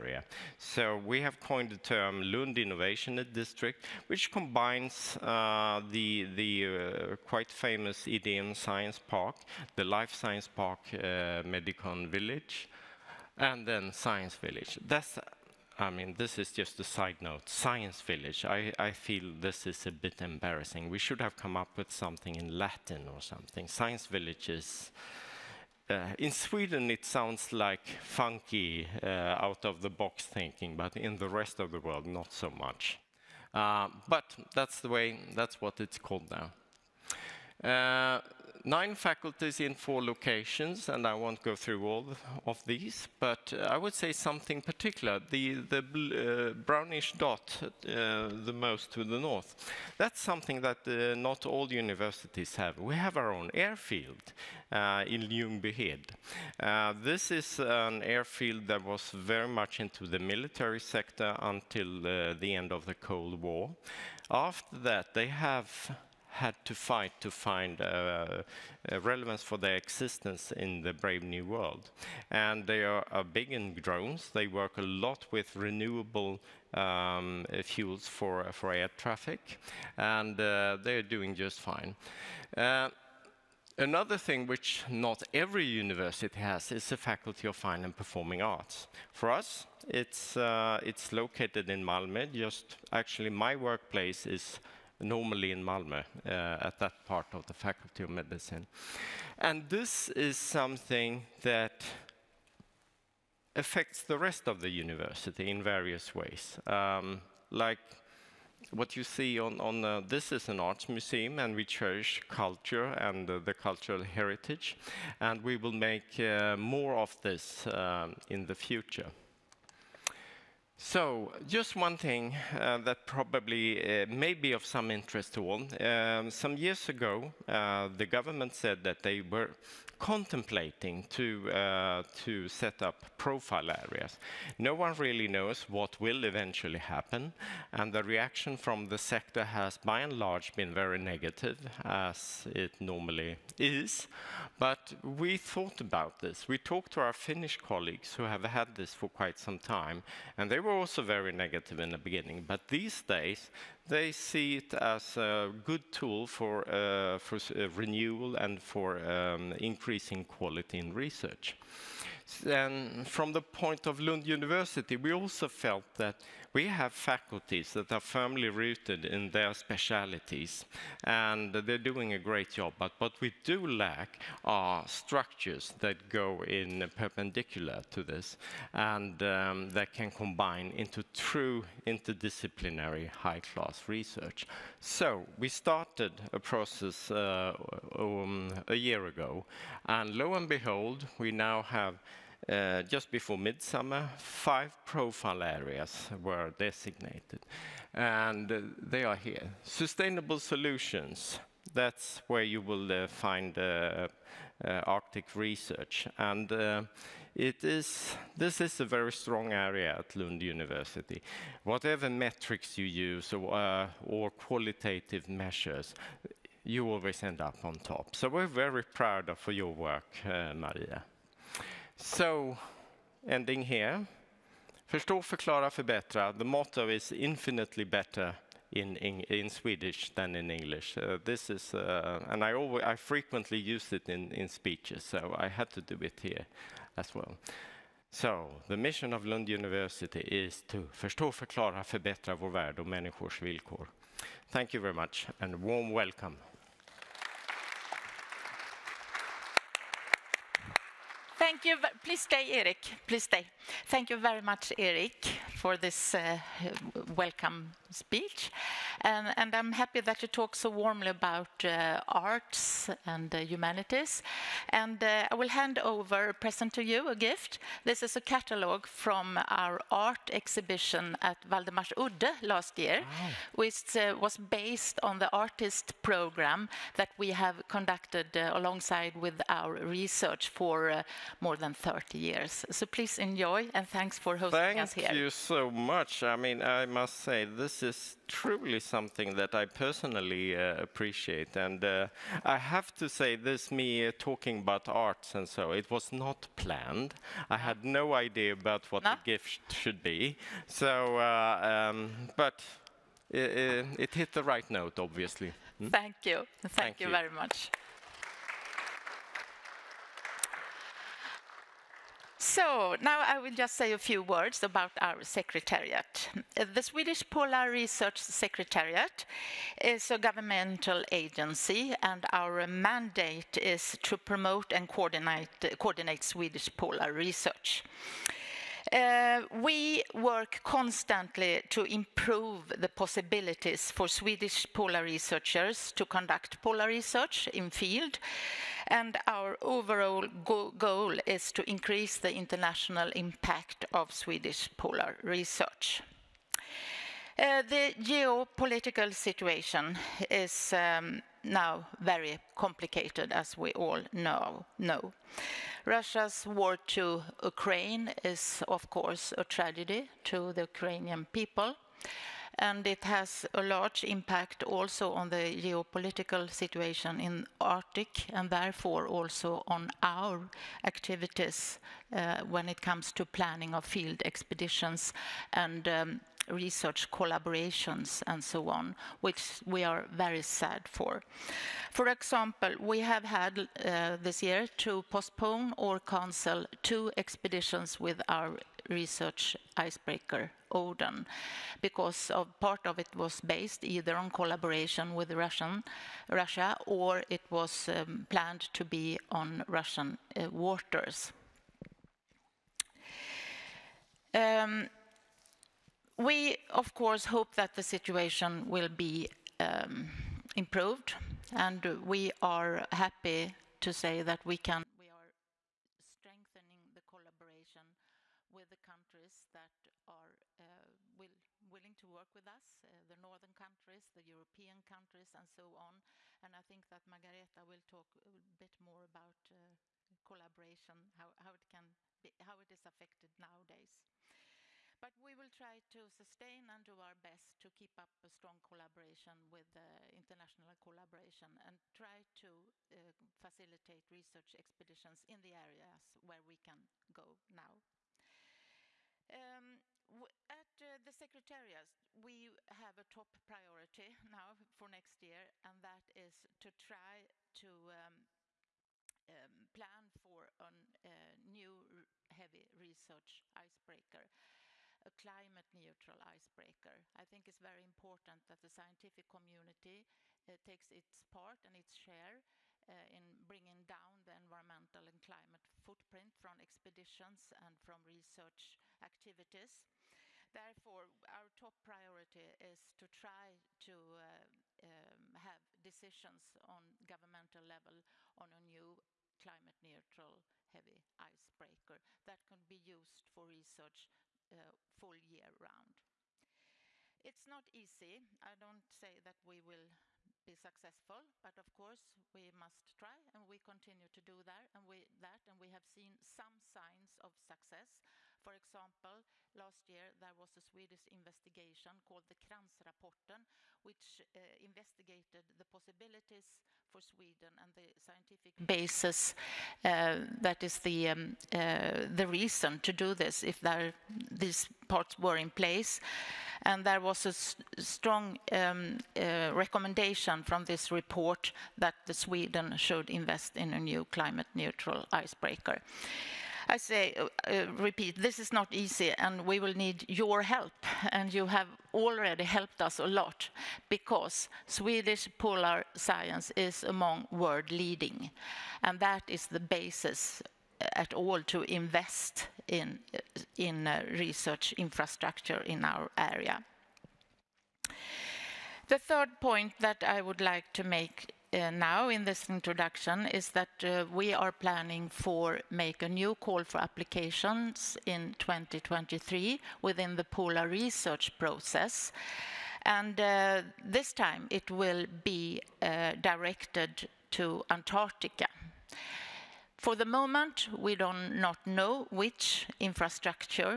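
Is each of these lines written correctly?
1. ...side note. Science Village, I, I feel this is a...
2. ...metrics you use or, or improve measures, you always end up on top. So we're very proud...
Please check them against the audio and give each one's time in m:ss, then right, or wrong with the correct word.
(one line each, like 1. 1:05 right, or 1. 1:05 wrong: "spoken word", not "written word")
1. 0:16 right
2. 3:32 wrong: "qualitative", not "improve".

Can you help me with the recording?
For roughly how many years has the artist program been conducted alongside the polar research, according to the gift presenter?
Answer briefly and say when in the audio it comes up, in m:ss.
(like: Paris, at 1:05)
More than 30, at 4:41.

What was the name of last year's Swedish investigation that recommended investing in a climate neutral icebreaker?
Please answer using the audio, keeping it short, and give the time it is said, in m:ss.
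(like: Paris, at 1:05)
Kranz Rapporten, at 8:32.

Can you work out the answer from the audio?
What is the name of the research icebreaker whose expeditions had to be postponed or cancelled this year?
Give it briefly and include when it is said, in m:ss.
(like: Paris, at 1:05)
Odin, at 6:30.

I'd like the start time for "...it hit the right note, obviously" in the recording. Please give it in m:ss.
5:03.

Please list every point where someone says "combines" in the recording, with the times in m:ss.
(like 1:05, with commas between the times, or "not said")
0:04, 3:00.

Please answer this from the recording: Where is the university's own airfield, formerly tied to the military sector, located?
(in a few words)
Ljungbyhed.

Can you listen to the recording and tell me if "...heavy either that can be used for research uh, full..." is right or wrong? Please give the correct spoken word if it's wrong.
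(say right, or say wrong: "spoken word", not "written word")
wrong: "icebreaker", not "either".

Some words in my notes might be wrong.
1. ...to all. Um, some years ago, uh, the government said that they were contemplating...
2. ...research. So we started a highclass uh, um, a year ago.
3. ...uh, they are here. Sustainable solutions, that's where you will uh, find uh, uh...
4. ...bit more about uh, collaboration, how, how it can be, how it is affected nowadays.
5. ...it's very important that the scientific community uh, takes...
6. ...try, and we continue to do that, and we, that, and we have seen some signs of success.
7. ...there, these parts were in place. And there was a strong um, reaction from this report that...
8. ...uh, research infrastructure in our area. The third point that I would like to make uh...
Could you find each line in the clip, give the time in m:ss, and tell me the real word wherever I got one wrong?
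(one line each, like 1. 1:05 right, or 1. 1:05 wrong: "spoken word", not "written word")
1. 2:05 right
2. 3:03 wrong: "process", not "highclass"
3. 3:18 right
4. 7:08 right
5. 7:47 right
6. 8:22 right
7. 8:43 wrong: "recommendation", not "reaction"
8. 9:13 right.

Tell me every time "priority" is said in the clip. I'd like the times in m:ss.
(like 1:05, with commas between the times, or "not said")
7:33, 8:01.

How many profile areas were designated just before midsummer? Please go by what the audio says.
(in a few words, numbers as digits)
5.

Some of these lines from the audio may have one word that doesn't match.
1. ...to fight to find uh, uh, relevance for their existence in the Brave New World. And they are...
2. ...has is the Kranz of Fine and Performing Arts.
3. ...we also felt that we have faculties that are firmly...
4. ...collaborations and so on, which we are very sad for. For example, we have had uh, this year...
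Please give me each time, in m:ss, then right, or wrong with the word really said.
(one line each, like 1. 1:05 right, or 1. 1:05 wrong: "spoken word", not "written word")
1. 1:06 right
2. 1:26 wrong: "Faculty", not "Kranz"
3. 2:44 right
4. 6:17 right.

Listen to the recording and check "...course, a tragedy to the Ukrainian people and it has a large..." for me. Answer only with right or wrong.
right.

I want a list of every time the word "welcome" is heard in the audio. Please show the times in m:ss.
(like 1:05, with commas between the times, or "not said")
4:05, 4:17.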